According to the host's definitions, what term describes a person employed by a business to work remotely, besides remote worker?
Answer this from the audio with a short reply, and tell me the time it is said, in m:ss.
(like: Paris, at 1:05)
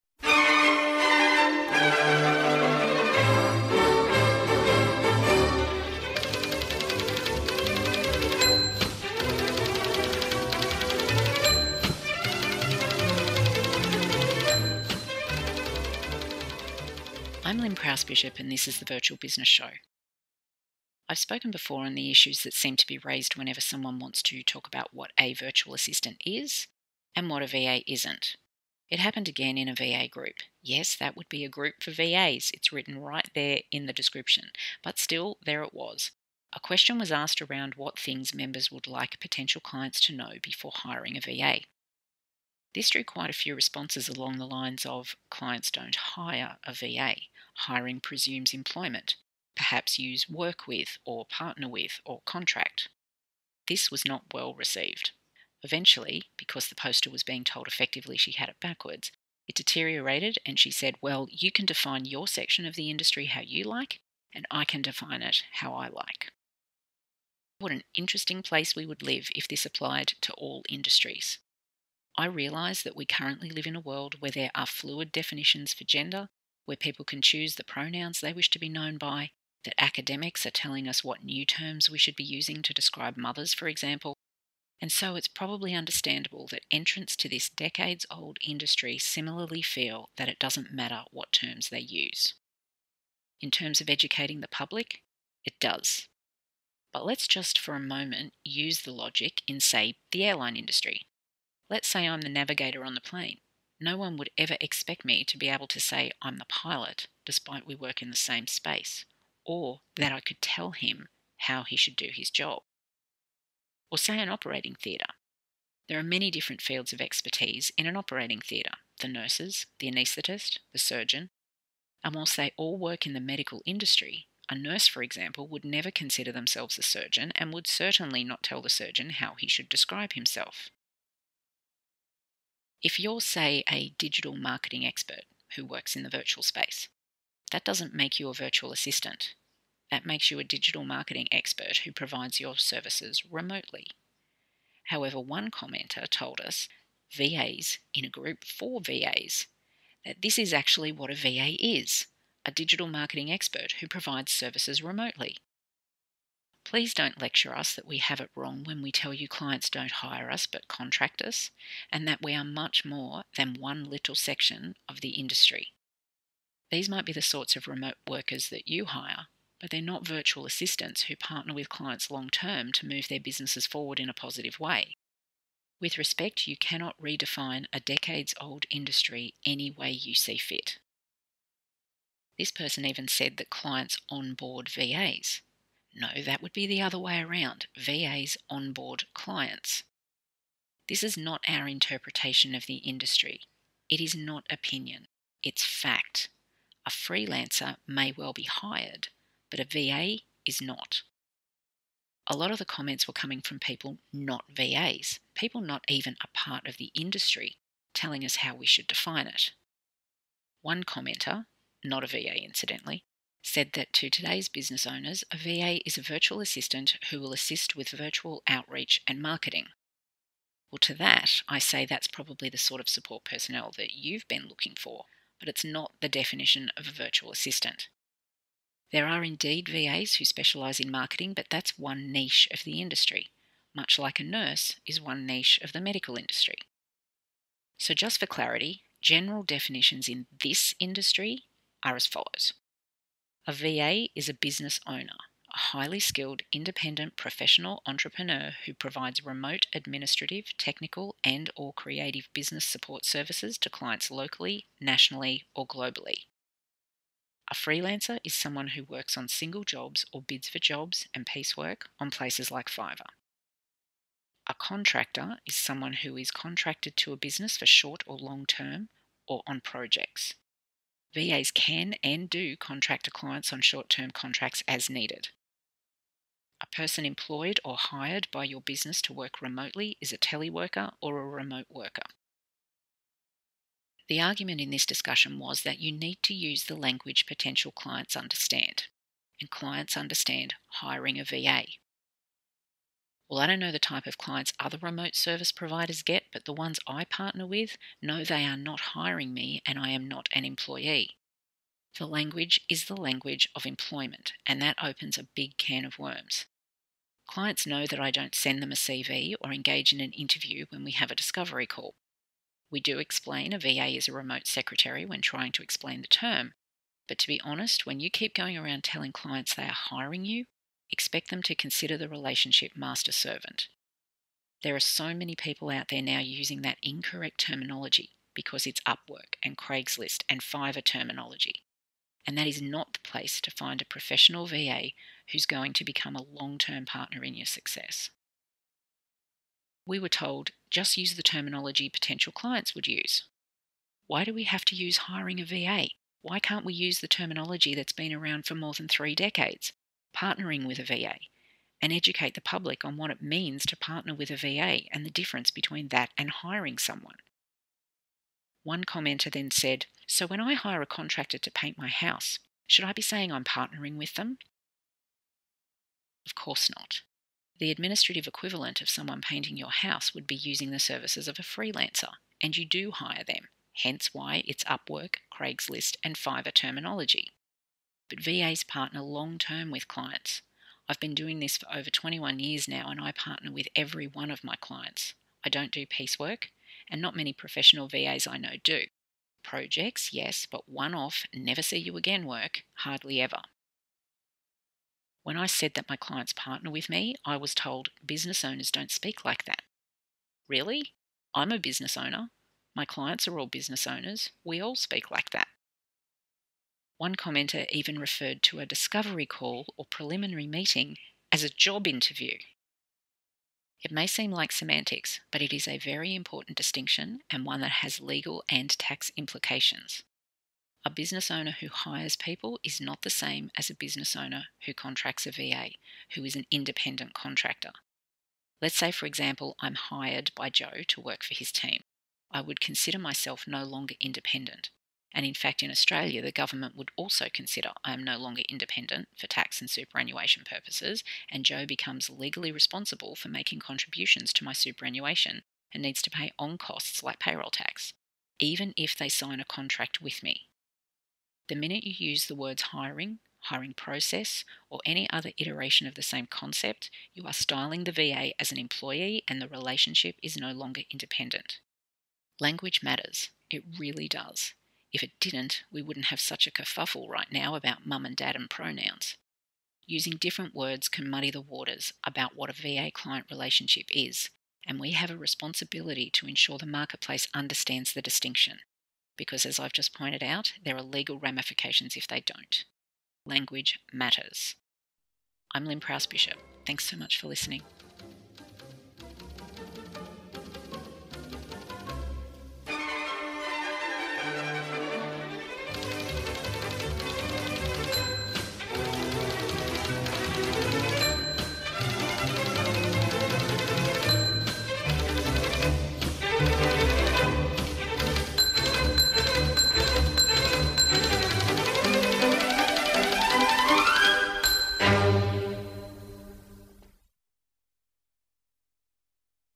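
teleworker, at 4:40.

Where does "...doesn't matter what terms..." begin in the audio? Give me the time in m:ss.
1:30.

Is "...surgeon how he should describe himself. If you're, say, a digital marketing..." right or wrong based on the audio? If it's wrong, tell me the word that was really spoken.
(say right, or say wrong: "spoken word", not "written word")
right.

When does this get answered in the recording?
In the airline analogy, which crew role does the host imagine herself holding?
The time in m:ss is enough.
1:42.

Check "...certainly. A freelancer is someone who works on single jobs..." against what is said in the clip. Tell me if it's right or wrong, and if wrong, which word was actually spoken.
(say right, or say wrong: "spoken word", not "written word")
wrong: "globally", not "certainly".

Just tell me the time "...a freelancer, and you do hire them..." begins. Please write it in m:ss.
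6:11.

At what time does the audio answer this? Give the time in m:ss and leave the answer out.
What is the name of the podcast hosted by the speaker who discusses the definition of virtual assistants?
0:18.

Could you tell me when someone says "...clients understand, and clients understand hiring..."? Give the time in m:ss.
4:47.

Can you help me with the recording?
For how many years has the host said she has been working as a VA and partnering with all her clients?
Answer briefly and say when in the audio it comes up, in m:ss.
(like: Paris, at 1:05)
21, at 6:21.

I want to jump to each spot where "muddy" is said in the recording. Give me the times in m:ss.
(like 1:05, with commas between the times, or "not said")
7:51.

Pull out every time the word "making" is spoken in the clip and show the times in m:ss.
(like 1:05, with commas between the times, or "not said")
7:23.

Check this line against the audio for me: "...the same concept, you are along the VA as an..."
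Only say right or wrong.
wrong.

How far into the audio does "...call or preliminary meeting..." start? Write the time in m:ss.
6:49.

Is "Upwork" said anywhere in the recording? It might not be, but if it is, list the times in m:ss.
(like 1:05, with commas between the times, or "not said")
5:28, 6:14.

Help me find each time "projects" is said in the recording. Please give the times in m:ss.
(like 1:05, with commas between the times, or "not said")
4:29, 6:29.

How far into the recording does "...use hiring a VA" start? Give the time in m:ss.
5:44.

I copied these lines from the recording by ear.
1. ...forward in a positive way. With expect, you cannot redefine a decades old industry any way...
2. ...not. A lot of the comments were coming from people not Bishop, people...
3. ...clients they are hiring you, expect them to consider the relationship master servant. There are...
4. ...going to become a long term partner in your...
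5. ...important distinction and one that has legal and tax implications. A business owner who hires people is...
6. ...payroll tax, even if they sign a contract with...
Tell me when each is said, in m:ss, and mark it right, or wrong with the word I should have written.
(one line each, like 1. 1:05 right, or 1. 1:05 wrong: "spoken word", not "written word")
1. 2:53 wrong: "respect", not "expect"
2. 3:20 wrong: "VAs", not "Bishop"
3. 5:19 right
4. 5:35 right
5. 6:56 right
6. 7:27 right.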